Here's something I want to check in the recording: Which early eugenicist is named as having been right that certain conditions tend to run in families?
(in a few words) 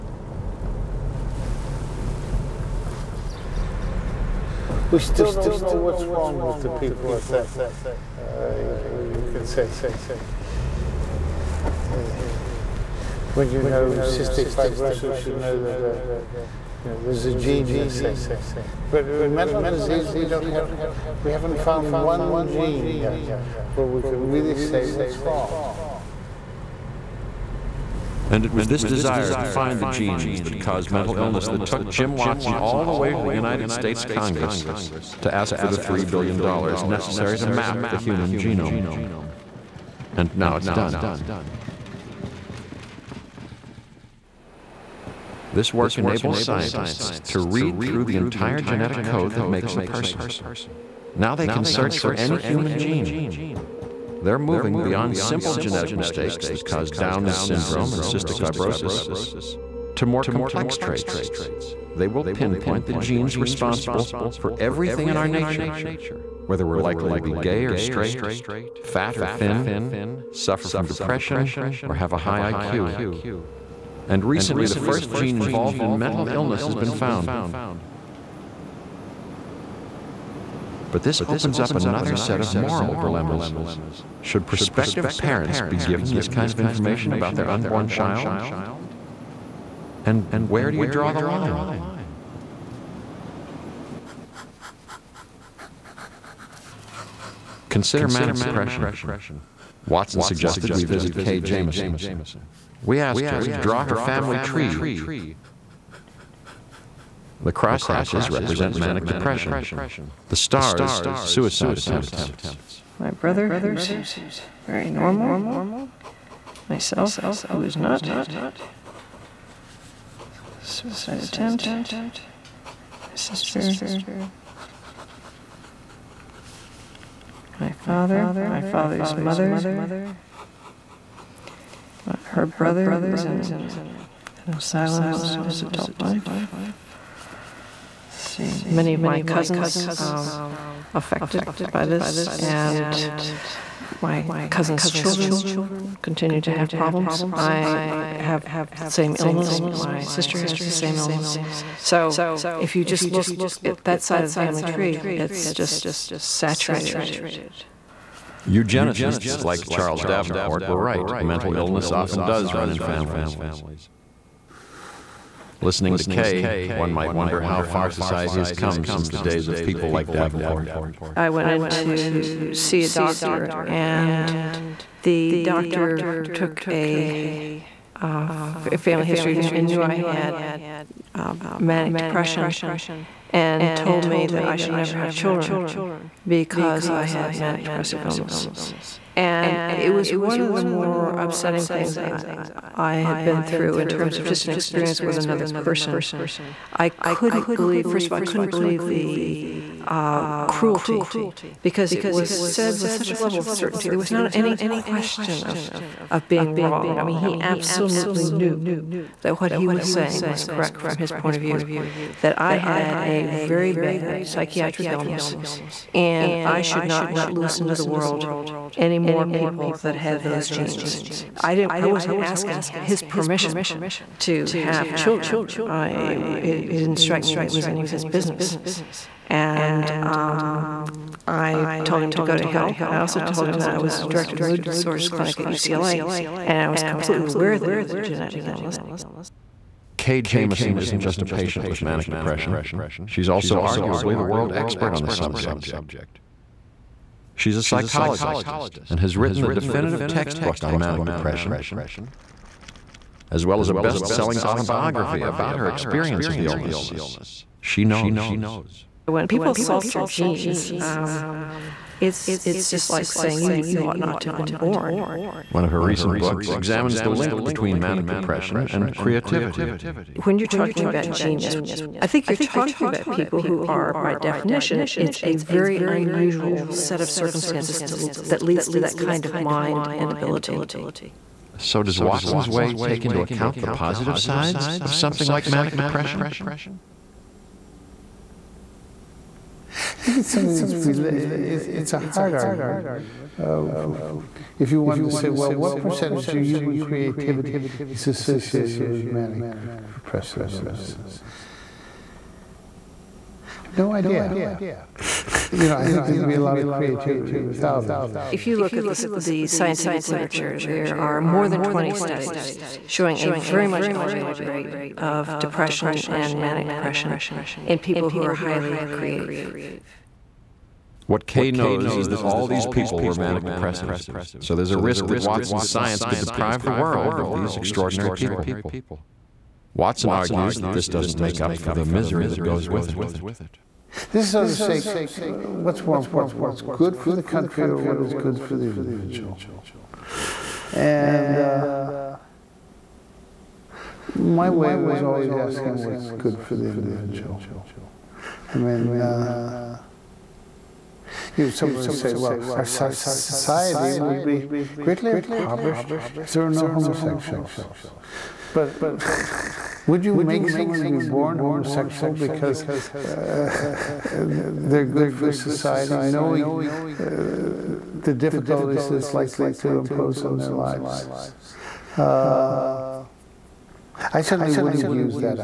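Charles Davenport.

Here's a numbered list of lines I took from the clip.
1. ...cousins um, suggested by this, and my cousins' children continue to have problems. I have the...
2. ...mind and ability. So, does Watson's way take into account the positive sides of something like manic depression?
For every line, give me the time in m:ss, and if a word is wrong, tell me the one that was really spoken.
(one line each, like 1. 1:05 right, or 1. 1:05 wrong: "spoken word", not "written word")
1. 2:19 wrong: "affected", not "suggested"
2. 4:39 right.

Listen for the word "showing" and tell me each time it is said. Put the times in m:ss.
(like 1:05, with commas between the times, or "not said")
5:12.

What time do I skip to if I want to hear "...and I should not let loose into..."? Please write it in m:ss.
3:35.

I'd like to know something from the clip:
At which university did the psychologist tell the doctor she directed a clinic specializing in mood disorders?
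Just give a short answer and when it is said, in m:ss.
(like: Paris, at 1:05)
UCLA, at 3:55.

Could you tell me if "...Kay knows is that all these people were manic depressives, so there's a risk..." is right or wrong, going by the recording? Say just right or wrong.
right.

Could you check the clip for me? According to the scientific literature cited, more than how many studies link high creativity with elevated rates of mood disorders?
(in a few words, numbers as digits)
20.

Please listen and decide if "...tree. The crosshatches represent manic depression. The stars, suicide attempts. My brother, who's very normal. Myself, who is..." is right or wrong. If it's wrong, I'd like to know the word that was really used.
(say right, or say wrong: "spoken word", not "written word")
right.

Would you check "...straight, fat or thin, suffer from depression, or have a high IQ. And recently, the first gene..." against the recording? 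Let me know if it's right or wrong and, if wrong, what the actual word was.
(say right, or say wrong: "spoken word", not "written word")
right.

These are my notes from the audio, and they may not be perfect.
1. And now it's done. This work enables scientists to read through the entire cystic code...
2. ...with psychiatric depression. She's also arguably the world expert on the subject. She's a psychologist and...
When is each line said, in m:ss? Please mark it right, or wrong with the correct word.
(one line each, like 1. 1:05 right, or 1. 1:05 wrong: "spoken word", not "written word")
1. 0:40 wrong: "genetic", not "cystic"
2. 4:01 wrong: "manic", not "psychiatric".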